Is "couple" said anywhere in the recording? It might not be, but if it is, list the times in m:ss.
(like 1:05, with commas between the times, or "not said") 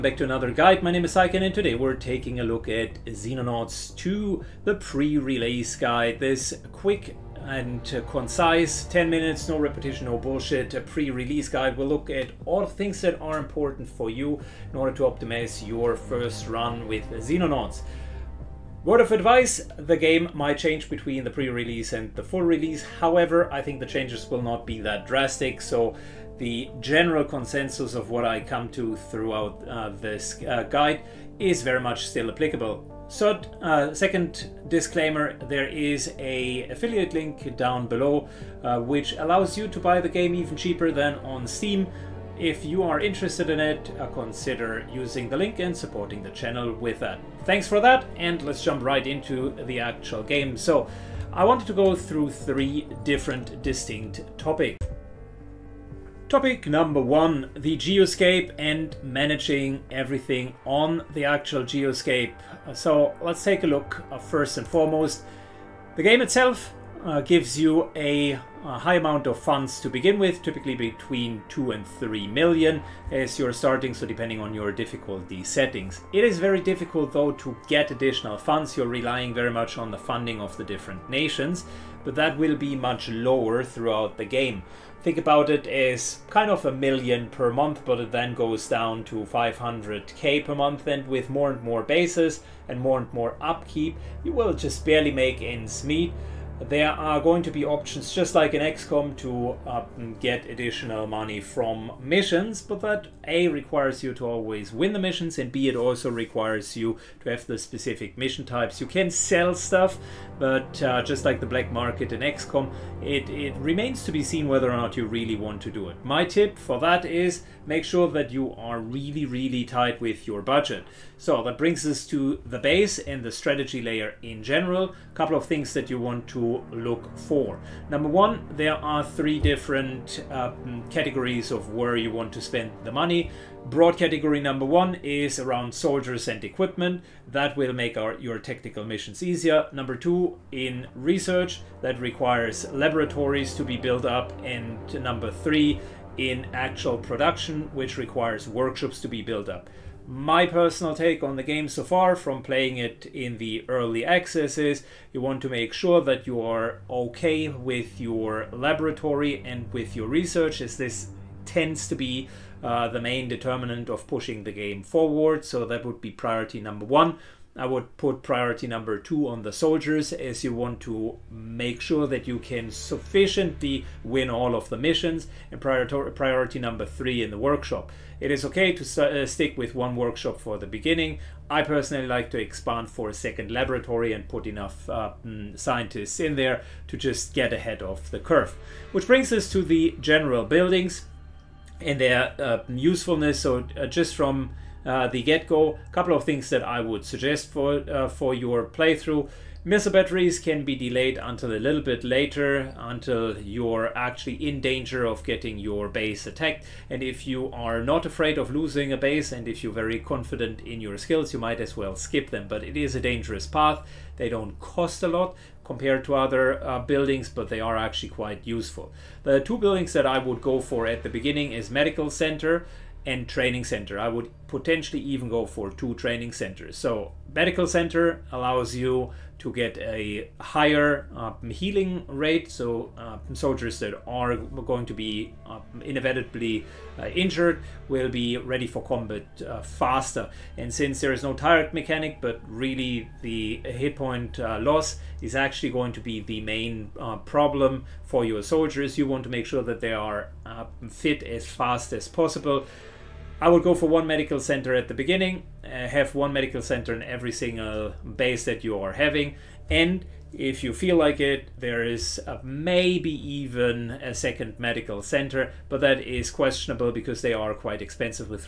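2:05, 3:15.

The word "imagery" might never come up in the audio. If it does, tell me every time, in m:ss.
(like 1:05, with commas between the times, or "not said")
not said.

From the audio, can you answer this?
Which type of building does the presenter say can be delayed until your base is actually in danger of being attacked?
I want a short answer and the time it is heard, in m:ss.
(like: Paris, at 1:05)
Missile batteries, at 3:19.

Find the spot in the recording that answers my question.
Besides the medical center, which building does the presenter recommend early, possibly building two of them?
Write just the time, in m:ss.
3:43.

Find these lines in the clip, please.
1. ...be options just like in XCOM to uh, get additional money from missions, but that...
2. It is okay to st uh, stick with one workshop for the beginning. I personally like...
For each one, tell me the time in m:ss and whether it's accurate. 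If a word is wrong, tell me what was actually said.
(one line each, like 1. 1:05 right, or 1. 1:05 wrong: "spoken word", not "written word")
1. 1:37 right
2. 2:58 right.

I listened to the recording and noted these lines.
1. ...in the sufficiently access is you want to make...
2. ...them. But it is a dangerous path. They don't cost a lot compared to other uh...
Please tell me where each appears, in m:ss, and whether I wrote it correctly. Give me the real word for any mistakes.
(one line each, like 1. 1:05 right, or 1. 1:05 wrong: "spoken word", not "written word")
1. 2:33 wrong: "early", not "sufficiently"
2. 3:32 right.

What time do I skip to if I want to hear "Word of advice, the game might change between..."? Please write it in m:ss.
0:18.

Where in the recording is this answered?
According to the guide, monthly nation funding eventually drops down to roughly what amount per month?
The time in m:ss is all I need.
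1:29.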